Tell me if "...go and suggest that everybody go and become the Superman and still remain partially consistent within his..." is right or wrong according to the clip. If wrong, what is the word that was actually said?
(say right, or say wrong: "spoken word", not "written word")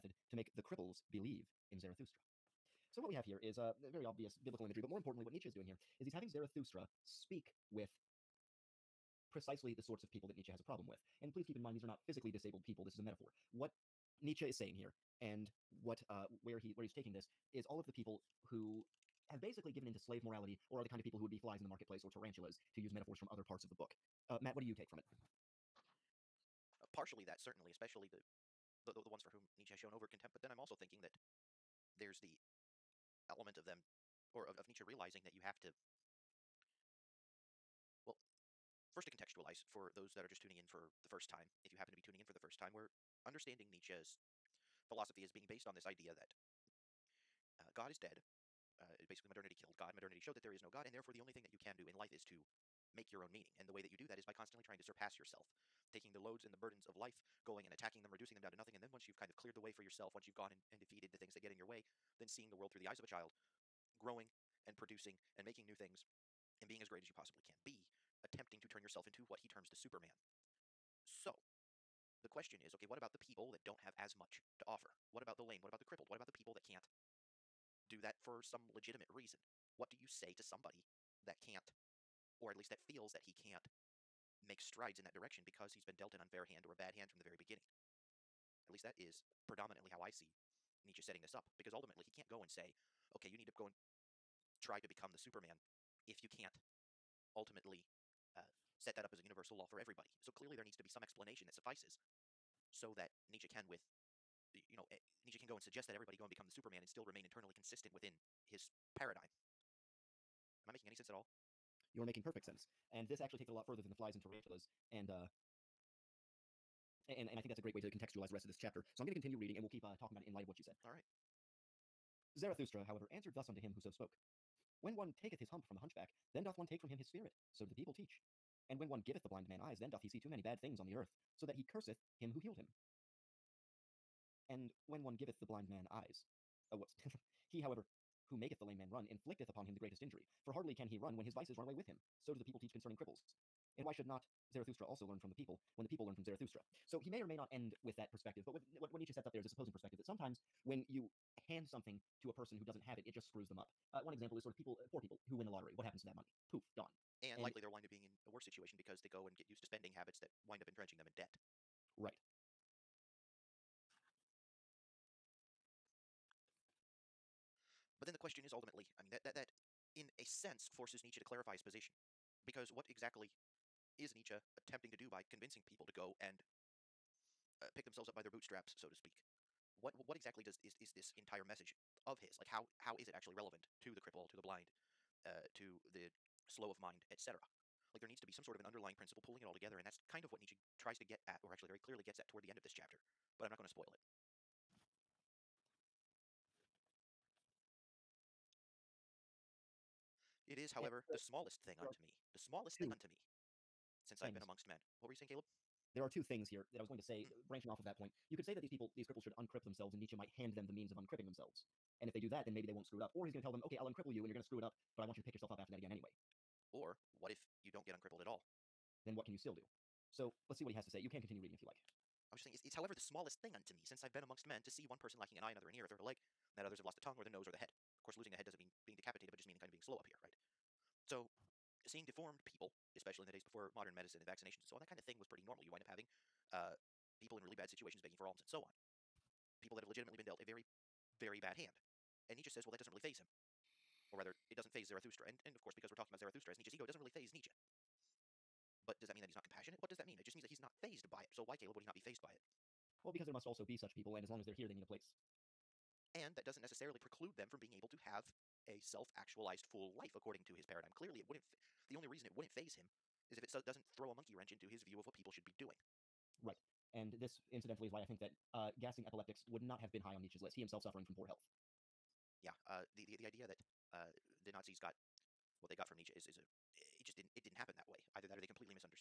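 wrong: "internally", not "partially".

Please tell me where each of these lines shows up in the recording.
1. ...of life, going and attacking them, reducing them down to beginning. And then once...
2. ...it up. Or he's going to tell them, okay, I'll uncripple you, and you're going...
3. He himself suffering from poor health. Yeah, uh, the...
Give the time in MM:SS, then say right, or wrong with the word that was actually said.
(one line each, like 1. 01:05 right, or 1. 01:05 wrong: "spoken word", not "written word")
1. 00:56 wrong: "nothing", not "beginning"
2. 03:32 right
3. 04:30 right.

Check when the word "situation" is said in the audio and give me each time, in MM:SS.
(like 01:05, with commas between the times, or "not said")
02:38, 03:57.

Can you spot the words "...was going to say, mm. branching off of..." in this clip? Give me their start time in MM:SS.
03:26.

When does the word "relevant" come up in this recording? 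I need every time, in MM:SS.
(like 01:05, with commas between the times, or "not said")
03:03.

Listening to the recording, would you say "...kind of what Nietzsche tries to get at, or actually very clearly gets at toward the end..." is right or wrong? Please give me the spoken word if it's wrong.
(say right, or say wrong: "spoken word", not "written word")
right.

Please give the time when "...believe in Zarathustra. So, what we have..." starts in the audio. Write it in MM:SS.
00:01.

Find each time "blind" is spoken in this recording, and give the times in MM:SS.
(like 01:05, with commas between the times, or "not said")
02:09, 02:15, 03:04.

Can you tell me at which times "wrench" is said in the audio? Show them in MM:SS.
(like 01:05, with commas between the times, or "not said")
04:24.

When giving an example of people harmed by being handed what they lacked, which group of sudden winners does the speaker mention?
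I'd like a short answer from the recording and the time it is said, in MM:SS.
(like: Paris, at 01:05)
Poor people who win the lottery, at 02:34.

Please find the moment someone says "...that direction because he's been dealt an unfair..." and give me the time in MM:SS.
01:25.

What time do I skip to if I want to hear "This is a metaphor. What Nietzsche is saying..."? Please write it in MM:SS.
00:12.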